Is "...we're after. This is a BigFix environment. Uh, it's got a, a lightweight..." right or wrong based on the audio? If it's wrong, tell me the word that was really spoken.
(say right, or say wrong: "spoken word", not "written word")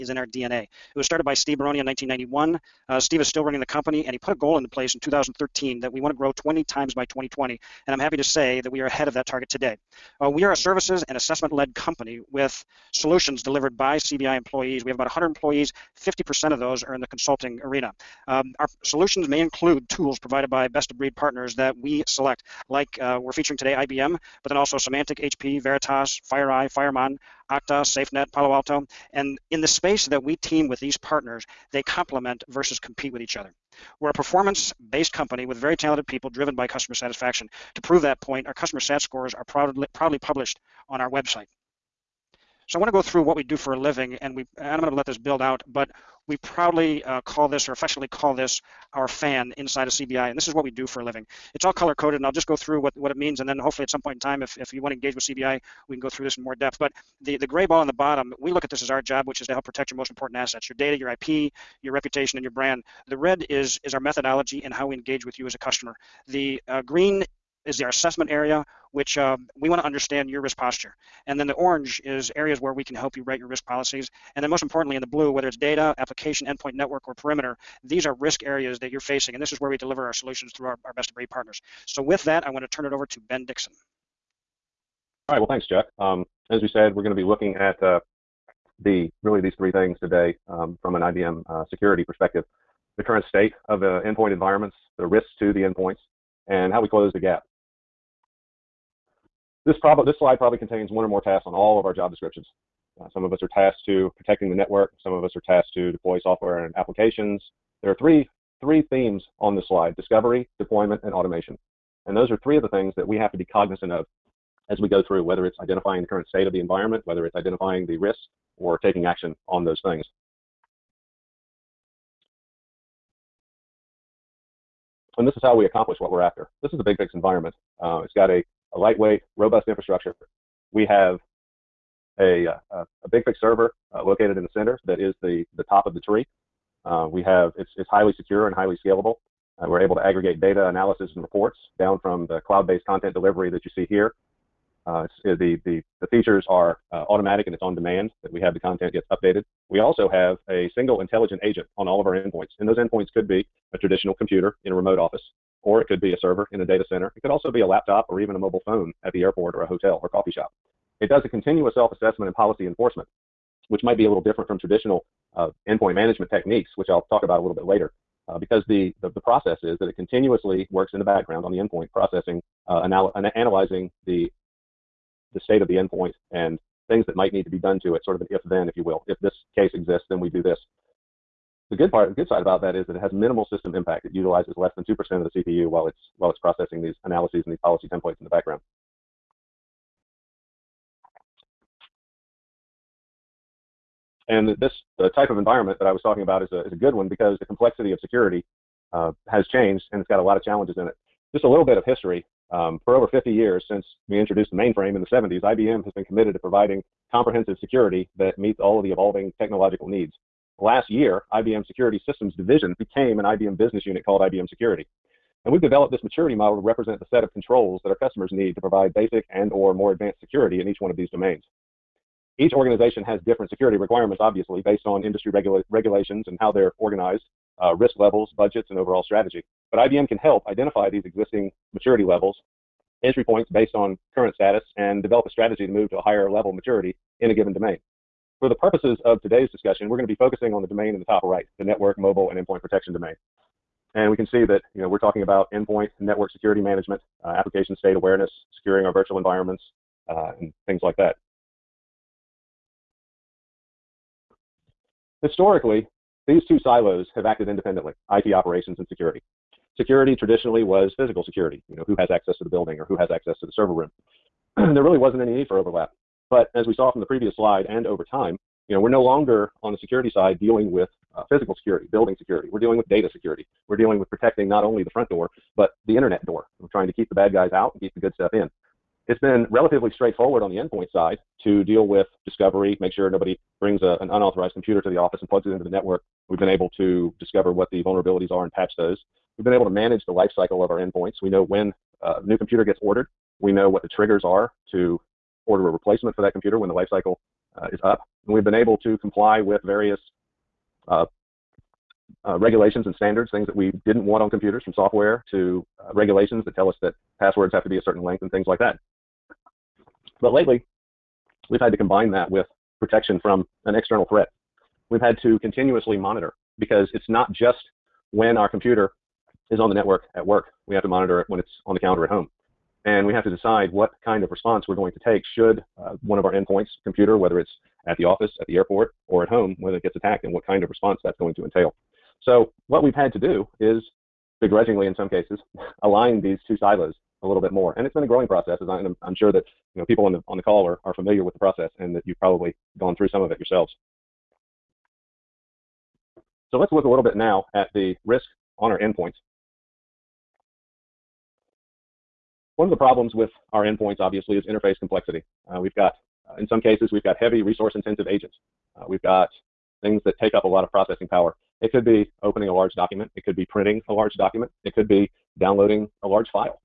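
right.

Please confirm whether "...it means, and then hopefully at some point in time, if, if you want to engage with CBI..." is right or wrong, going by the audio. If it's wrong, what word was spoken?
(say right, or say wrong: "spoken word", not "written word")
right.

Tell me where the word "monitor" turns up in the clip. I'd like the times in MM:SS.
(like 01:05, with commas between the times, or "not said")
05:15, 05:20.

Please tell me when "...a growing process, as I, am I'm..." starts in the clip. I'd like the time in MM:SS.
05:38.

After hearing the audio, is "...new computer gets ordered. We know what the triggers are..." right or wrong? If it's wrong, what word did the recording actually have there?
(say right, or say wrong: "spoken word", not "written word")
right.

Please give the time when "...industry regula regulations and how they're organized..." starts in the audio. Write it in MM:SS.
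03:45.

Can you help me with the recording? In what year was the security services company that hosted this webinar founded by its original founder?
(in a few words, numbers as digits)
1991.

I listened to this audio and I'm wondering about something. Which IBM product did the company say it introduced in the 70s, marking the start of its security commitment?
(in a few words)
mainframe.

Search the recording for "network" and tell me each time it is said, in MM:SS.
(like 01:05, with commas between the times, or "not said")
01:16, 01:44, 04:01, 04:05, 04:45, 05:19.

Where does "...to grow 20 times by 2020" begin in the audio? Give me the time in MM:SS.
00:06.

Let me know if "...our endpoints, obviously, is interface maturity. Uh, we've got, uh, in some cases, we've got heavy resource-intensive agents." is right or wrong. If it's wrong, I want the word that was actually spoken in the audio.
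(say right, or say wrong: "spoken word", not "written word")
wrong: "complexity", not "maturity".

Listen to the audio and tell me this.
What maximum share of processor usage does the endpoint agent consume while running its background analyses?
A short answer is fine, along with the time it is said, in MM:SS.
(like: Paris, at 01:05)
2%, at 03:04.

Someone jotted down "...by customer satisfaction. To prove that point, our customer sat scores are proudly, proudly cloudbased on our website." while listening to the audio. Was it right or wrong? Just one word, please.
wrong.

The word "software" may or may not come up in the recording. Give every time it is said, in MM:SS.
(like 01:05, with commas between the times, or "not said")
01:46, 05:04.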